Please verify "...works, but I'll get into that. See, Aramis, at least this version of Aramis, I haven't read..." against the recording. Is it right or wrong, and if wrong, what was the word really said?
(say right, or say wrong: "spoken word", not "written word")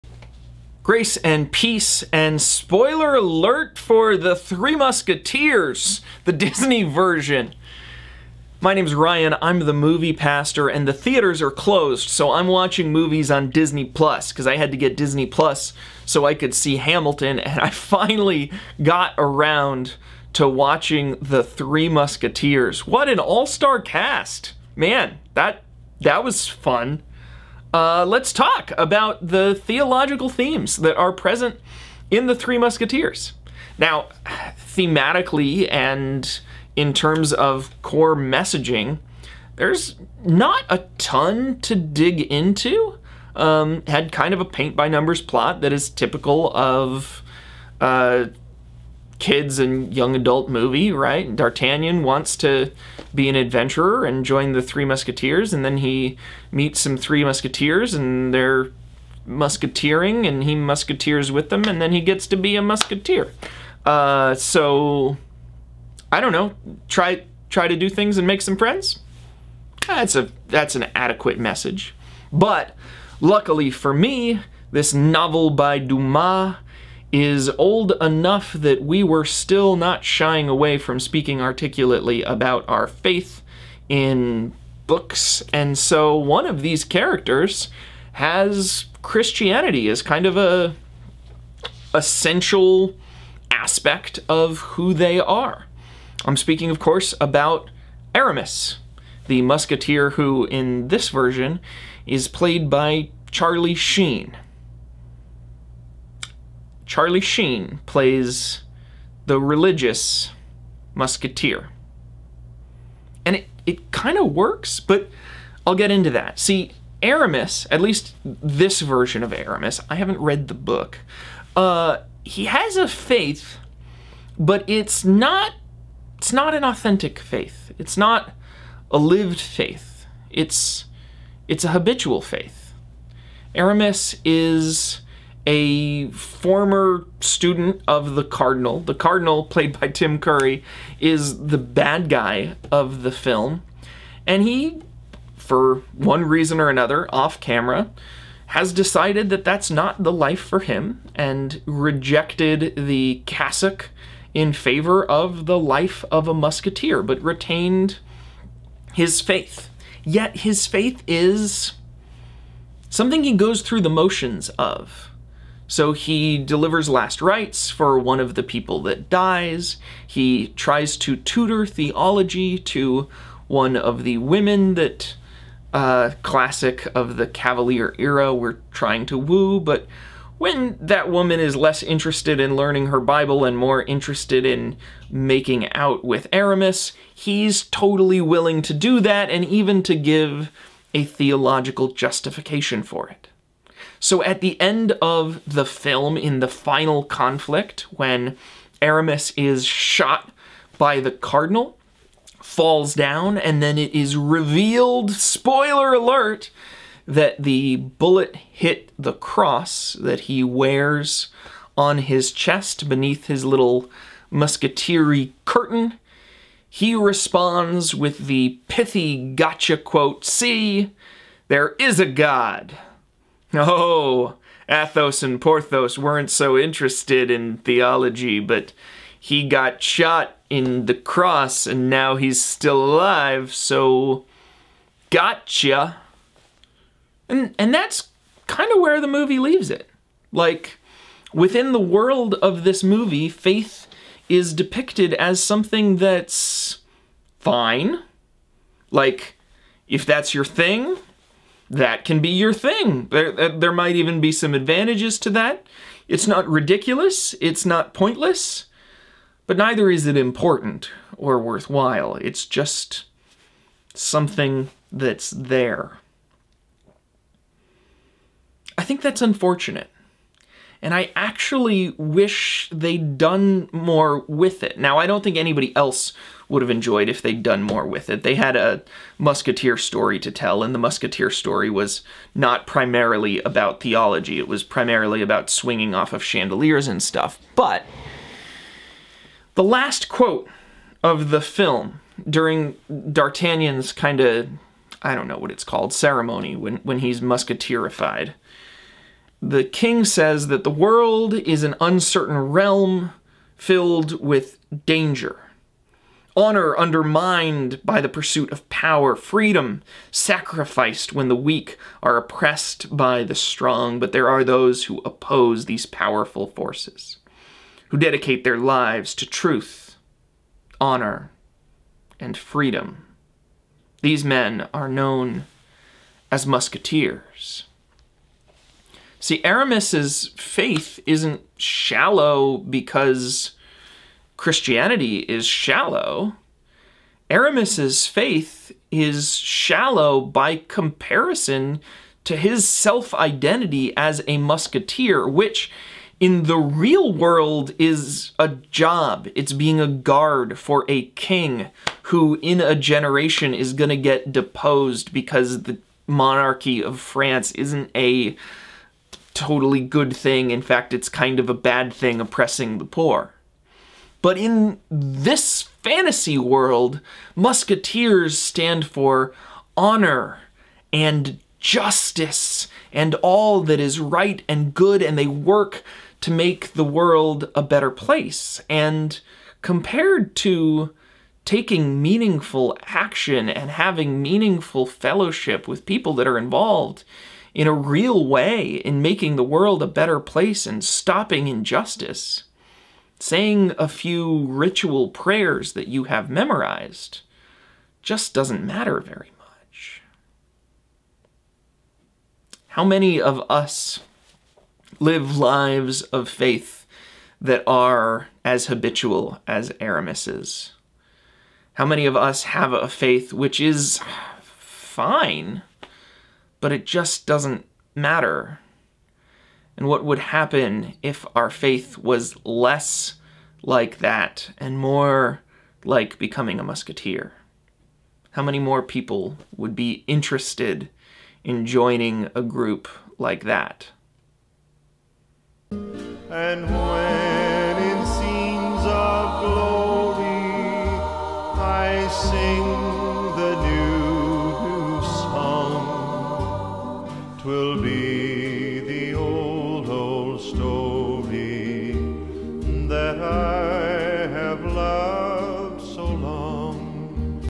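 right.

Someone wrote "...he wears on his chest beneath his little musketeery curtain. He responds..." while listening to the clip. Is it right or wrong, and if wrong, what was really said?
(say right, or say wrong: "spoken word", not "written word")
right.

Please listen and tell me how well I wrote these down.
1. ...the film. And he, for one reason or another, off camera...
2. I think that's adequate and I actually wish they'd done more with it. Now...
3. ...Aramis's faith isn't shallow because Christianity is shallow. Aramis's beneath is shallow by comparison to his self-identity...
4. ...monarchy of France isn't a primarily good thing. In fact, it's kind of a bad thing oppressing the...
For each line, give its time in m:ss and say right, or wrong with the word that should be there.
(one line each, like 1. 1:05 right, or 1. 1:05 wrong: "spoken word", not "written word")
1. 2:23 right
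2. 4:28 wrong: "unfortunate", not "adequate"
3. 5:29 wrong: "faith", not "beneath"
4. 5:56 wrong: "totally", not "primarily".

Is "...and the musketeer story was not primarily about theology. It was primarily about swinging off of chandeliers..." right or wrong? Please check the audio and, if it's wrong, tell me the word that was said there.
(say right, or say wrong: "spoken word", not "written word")
right.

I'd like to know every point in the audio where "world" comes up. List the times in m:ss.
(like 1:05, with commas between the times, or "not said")
4:01, 5:00, 5:47, 6:06, 6:16, 6:29.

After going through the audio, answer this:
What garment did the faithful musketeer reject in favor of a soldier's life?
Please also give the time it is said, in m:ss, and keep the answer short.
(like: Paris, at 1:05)
the cassock, at 2:32.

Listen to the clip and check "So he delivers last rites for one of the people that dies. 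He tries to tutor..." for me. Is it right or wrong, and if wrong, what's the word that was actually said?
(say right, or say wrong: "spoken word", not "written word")
right.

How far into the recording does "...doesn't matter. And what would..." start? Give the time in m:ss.
6:57.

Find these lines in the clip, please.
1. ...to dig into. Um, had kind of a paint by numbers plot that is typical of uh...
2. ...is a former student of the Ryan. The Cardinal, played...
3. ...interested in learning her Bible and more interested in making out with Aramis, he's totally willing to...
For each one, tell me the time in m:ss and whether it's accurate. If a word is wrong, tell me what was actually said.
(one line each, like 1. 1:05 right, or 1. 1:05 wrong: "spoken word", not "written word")
1. 0:41 right
2. 2:14 wrong: "Cardinal", not "Ryan"
3. 3:01 right.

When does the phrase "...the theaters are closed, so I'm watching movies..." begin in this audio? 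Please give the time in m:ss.
0:10.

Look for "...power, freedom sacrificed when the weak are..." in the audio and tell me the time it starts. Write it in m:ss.
5:08.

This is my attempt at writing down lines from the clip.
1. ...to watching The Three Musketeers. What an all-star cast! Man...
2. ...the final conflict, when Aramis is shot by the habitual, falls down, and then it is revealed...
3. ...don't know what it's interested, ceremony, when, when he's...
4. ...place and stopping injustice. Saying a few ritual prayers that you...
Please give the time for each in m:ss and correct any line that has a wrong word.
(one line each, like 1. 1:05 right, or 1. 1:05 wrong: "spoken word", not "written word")
1. 0:20 right
2. 3:16 wrong: "cardinal", not "habitual"
3. 4:55 wrong: "called", not "interested"
4. 6:30 right.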